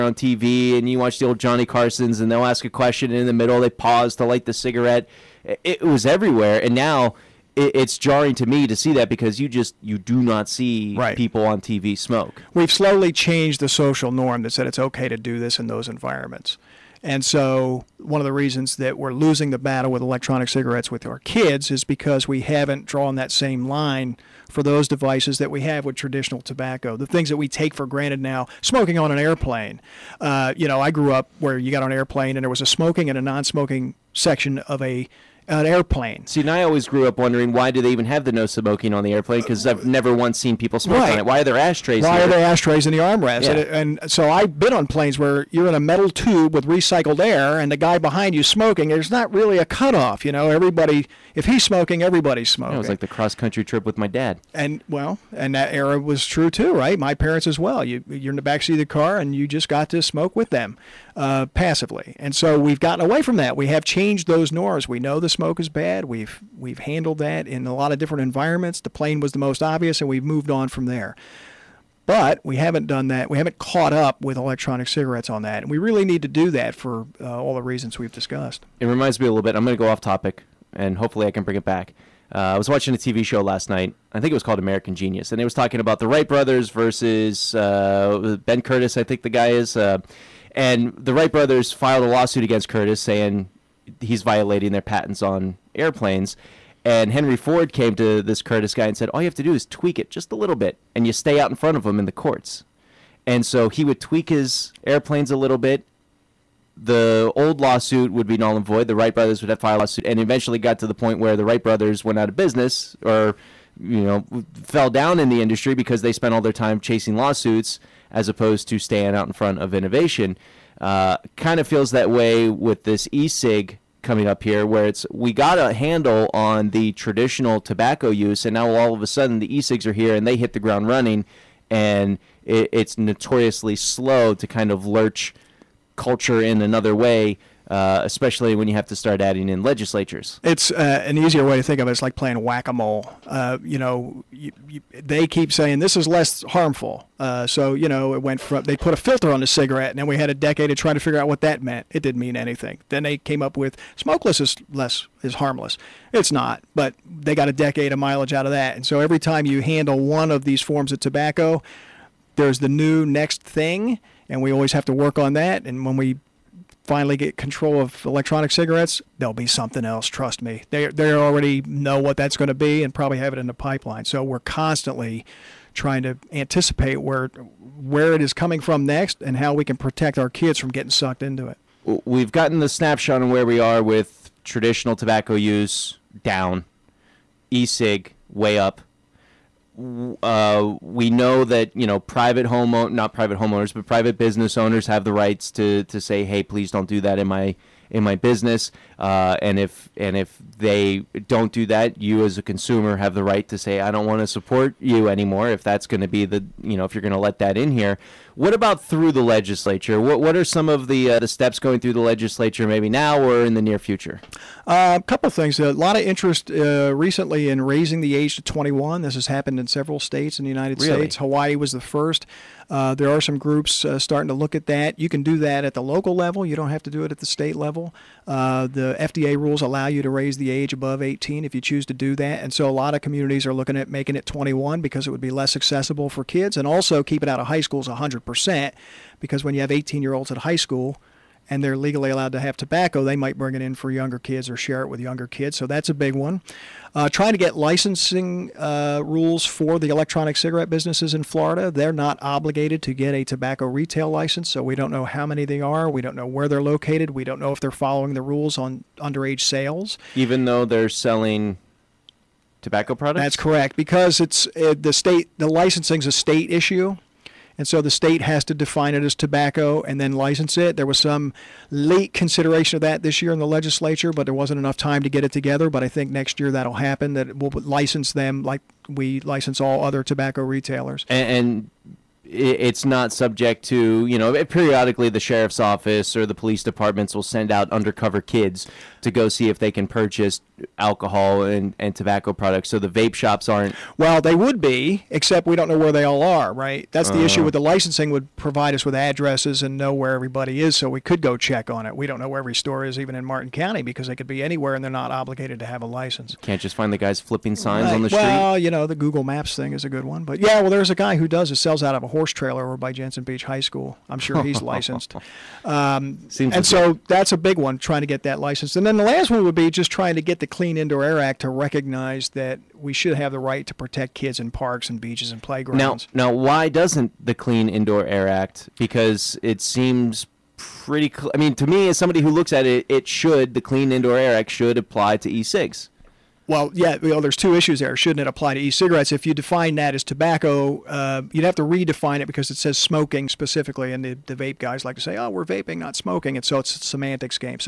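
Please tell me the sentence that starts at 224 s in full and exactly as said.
You can do that at the local level.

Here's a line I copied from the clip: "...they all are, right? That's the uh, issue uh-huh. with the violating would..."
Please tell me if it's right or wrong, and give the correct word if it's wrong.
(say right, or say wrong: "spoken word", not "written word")
wrong: "licensing", not "violating".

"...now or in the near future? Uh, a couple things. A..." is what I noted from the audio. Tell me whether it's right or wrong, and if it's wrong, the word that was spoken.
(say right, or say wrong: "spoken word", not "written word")
right.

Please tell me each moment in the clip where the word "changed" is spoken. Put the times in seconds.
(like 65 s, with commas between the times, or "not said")
13 s, 63 s.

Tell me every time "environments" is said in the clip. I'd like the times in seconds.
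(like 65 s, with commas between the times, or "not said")
15 s, 68 s.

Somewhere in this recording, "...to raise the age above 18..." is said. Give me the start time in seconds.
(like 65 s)
230 s.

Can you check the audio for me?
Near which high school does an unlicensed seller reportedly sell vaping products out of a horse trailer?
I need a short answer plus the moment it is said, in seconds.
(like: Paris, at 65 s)
Jensen Beach High School, at 312 s.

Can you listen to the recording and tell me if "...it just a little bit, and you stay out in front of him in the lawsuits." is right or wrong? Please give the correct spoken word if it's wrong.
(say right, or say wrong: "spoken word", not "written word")
wrong: "courts", not "lawsuits".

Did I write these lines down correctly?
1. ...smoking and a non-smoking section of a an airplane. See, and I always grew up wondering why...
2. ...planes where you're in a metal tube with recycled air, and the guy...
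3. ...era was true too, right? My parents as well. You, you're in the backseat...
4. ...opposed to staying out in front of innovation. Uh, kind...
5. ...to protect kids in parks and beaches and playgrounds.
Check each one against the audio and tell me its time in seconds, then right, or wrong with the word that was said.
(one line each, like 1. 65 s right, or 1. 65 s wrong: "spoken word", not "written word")
1. 32 s right
2. 44 s right
3. 55 s right
4. 118 s right
5. 323 s right.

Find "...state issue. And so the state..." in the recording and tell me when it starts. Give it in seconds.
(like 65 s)
266 s.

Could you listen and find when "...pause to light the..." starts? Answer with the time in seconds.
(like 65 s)
3 s.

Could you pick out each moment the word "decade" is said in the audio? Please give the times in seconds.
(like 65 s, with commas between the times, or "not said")
150 s, 157 s.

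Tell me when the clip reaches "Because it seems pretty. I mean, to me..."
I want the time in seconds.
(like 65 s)
328 s.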